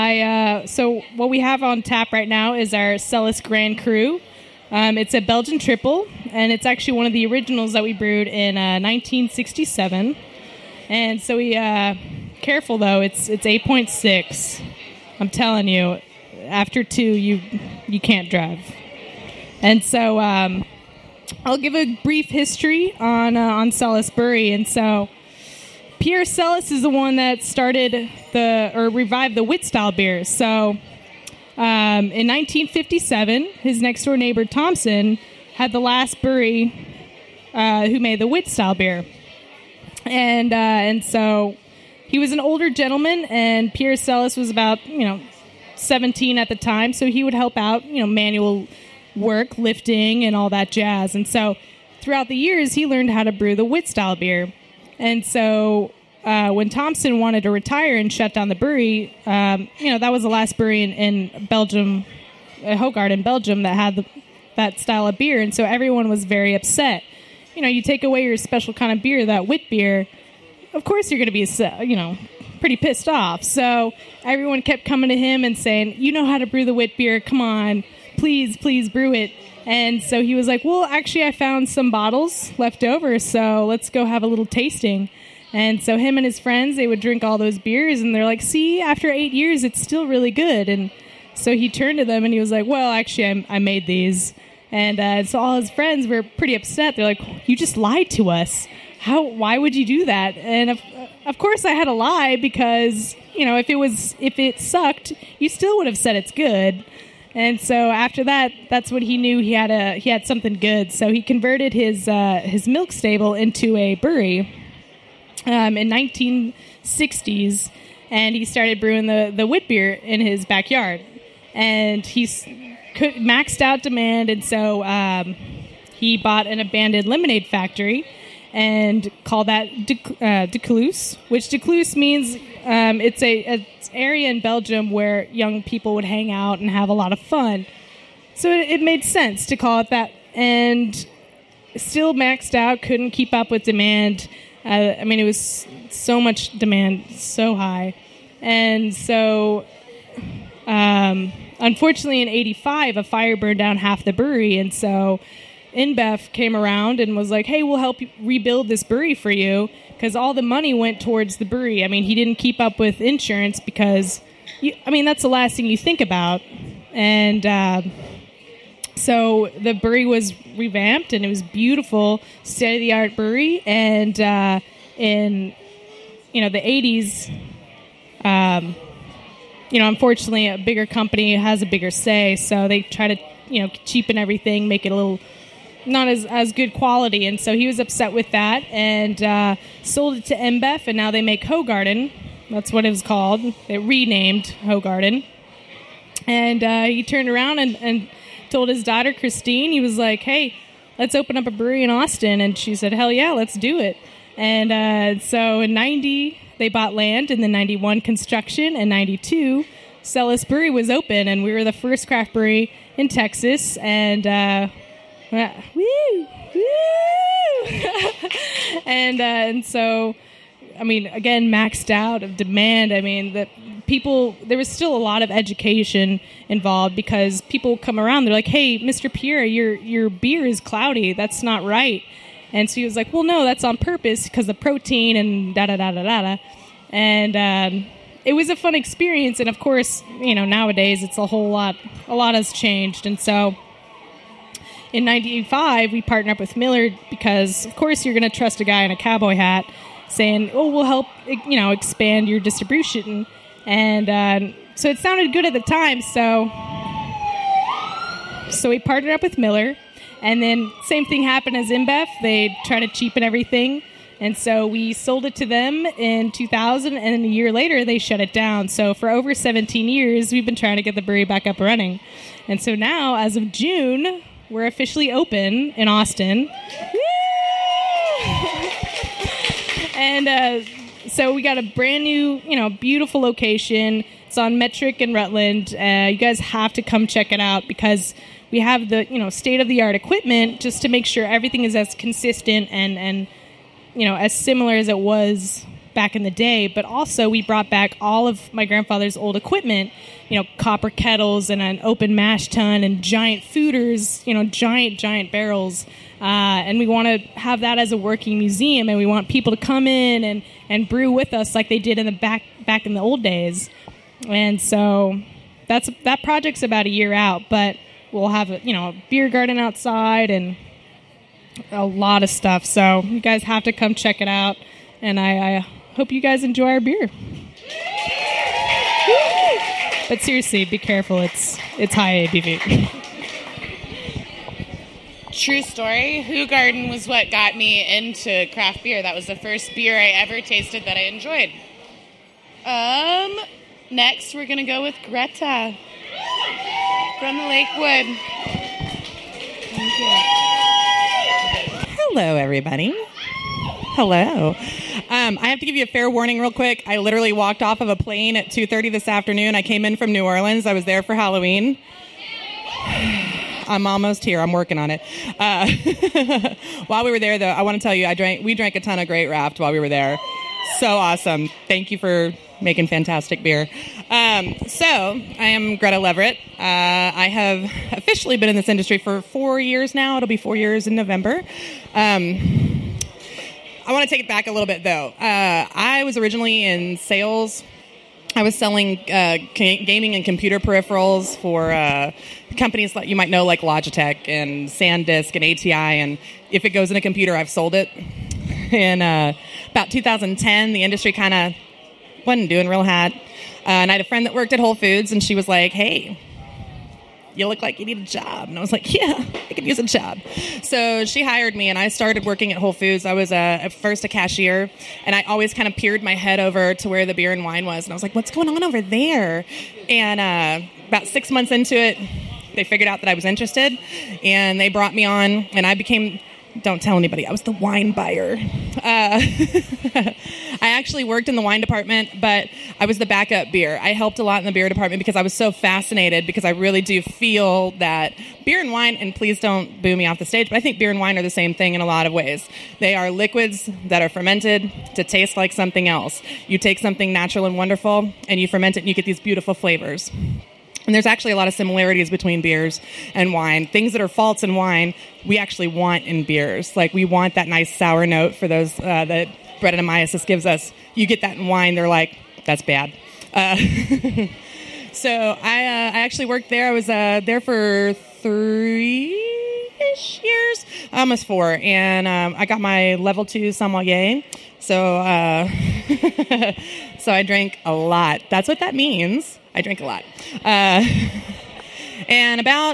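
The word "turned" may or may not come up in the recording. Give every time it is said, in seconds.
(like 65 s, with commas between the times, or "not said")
91 s, 197 s.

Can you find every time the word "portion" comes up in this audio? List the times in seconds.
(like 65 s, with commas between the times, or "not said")
not said.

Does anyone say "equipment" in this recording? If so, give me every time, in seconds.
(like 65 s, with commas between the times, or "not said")
289 s, 299 s.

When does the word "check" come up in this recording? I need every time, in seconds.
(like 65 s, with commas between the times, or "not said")
287 s, 323 s.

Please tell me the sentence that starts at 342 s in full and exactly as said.
Um, next we're gonna go with Greta from the Lakewood.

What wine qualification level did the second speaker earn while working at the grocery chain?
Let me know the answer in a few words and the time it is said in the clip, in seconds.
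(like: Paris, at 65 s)
level two sommelier, at 472 s.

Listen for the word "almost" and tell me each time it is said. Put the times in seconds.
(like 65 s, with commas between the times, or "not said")
363 s, 470 s.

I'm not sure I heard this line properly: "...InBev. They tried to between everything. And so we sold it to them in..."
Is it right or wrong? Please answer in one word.
wrong.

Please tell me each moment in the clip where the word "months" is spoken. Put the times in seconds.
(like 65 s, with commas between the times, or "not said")
421 s.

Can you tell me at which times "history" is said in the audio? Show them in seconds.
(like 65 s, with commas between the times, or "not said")
22 s.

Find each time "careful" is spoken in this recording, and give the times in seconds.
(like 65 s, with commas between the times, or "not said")
12 s, 330 s.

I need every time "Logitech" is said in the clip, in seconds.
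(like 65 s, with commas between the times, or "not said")
393 s.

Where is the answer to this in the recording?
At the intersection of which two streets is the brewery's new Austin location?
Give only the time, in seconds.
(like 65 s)
284 s.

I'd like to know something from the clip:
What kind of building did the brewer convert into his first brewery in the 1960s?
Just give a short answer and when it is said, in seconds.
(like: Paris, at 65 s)
milk stable, at 112 s.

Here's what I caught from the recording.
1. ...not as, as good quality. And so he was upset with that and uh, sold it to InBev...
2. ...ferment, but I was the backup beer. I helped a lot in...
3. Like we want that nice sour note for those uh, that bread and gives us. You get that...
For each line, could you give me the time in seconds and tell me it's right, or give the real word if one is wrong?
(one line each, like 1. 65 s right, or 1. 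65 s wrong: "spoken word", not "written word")
1. 185 s right
2. 431 s wrong: "department", not "ferment"
3. 456 s right.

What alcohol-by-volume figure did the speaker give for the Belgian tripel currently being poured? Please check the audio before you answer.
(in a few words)
8.6.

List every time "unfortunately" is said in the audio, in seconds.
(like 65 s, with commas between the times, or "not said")
151 s, 179 s.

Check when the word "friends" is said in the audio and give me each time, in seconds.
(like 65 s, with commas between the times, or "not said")
86 s, 95 s, 404 s.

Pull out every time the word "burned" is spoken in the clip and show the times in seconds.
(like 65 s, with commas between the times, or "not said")
153 s.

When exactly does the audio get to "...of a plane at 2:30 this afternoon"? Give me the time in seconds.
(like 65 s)
357 s.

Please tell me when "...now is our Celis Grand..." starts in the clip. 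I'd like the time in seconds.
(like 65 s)
2 s.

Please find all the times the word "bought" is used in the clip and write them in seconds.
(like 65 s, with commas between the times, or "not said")
126 s, 206 s.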